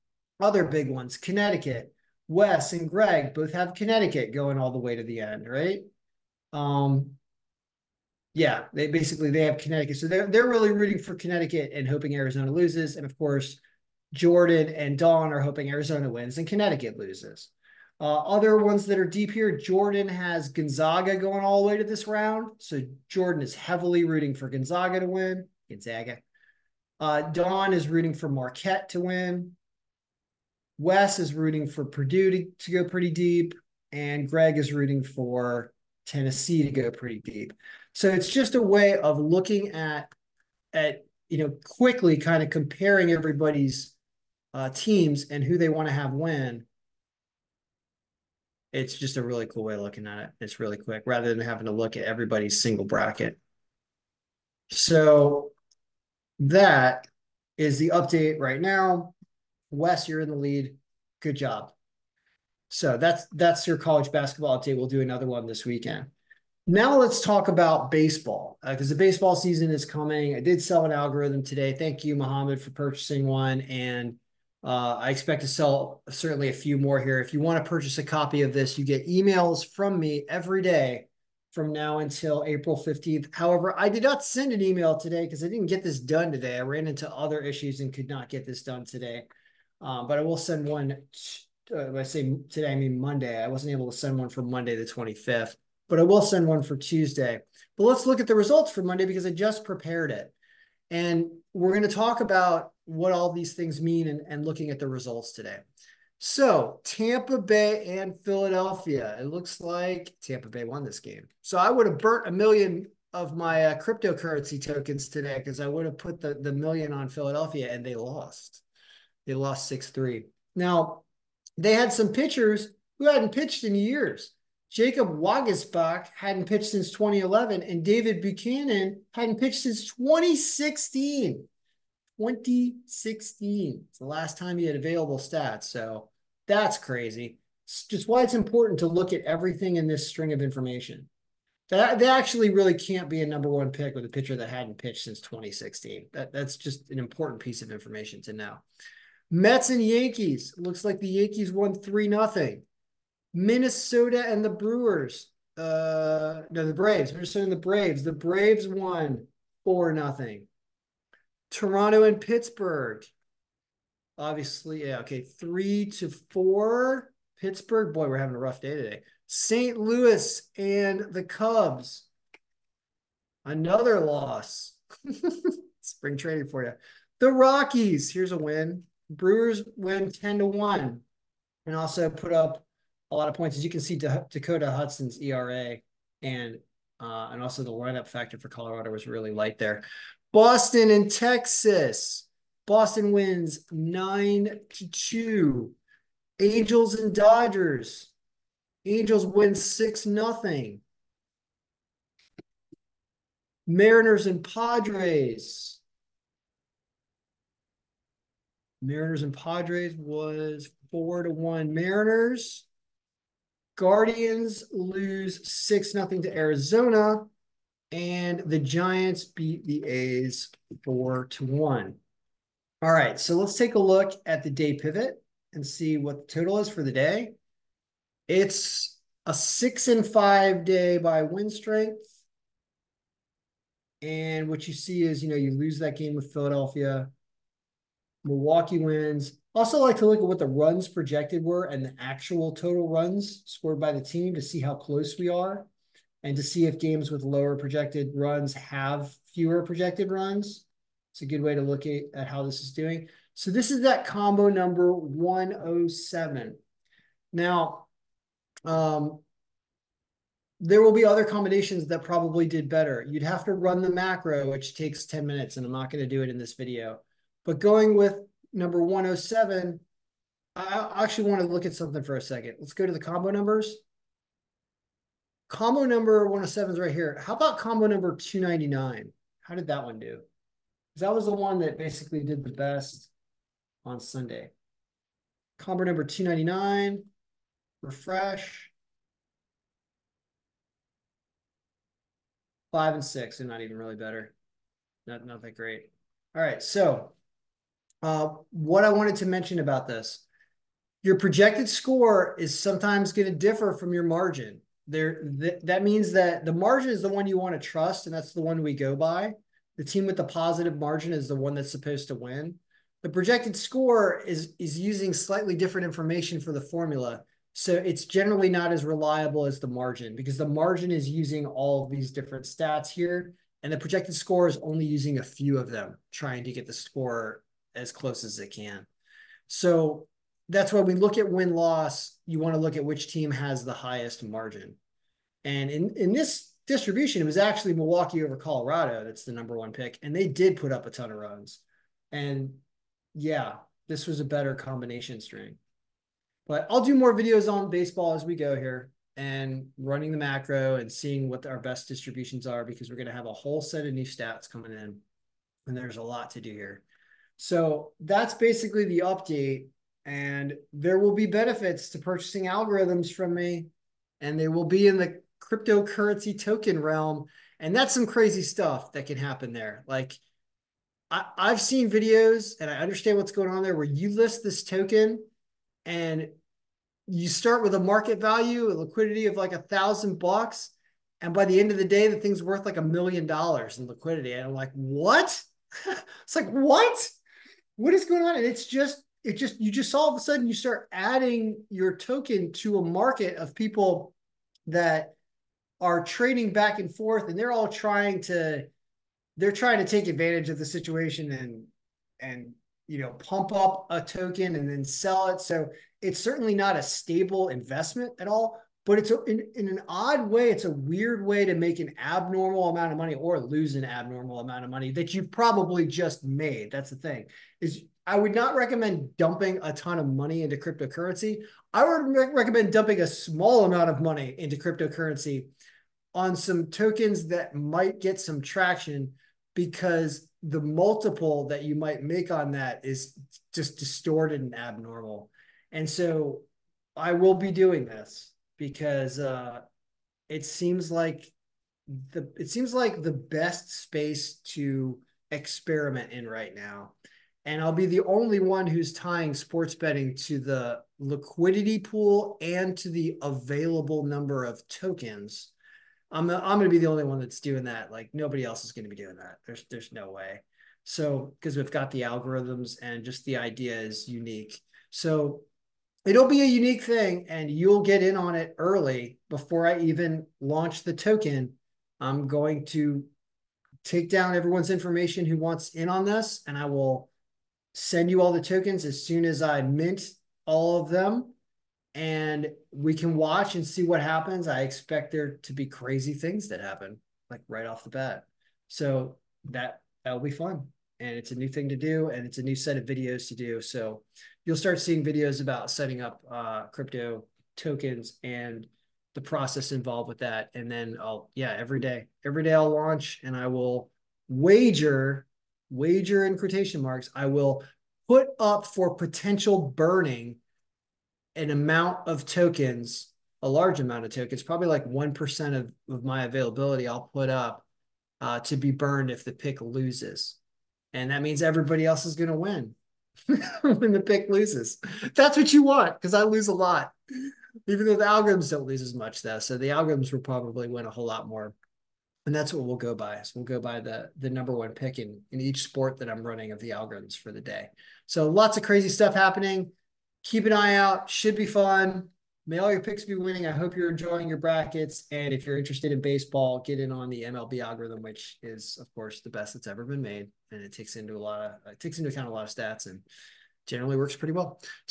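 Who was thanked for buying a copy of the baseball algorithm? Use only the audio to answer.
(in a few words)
Mohammed.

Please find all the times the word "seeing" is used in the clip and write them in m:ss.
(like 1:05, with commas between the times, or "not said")
5:50, 8:14.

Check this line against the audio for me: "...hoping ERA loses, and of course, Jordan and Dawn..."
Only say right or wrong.
wrong.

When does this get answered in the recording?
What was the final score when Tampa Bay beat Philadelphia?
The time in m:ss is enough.
1:59.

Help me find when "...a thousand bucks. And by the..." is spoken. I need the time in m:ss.
6:19.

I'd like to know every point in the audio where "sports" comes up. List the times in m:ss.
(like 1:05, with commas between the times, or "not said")
7:29, 8:55.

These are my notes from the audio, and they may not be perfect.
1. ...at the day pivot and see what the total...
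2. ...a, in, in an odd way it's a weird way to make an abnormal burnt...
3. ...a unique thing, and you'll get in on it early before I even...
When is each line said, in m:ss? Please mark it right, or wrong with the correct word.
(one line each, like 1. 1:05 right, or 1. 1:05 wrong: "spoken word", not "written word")
1. 3:44 right
2. 6:49 wrong: "amount", not "burnt"
3. 7:46 right.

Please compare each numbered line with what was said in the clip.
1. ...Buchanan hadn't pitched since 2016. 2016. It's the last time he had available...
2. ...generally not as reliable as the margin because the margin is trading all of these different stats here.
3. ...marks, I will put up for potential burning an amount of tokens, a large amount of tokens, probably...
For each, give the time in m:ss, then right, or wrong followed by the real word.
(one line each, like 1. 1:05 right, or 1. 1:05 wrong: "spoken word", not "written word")
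1. 2:08 right
2. 5:18 wrong: "using", not "trading"
3. 8:26 right.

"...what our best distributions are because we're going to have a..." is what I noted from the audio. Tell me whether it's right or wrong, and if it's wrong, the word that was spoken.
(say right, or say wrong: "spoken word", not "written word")
right.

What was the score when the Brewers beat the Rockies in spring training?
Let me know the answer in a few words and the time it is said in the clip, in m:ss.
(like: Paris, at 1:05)
10 to 1, at 3:00.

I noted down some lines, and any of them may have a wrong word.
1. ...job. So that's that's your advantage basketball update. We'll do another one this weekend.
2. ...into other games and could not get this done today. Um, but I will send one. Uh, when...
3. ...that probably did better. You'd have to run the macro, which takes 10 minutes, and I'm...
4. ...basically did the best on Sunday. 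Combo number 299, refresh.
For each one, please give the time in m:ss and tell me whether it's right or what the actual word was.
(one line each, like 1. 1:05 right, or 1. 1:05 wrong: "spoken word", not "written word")
1. 1:01 wrong: "college", not "advantage"
2. 1:26 wrong: "issues", not "games"
3. 4:21 right
4. 4:41 right.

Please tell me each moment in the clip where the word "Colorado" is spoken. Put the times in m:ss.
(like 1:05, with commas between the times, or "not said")
3:08, 5:38.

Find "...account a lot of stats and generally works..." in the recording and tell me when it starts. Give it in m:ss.
9:12.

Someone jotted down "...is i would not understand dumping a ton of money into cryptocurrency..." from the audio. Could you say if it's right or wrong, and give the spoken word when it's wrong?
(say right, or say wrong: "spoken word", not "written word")
wrong: "recommend", not "understand".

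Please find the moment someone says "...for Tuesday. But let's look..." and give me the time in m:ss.
1:36.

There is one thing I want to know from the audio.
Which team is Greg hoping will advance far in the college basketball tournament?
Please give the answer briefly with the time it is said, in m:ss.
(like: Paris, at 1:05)
Tennessee, at 0:36.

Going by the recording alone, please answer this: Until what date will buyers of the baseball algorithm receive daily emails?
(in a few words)
April 15th.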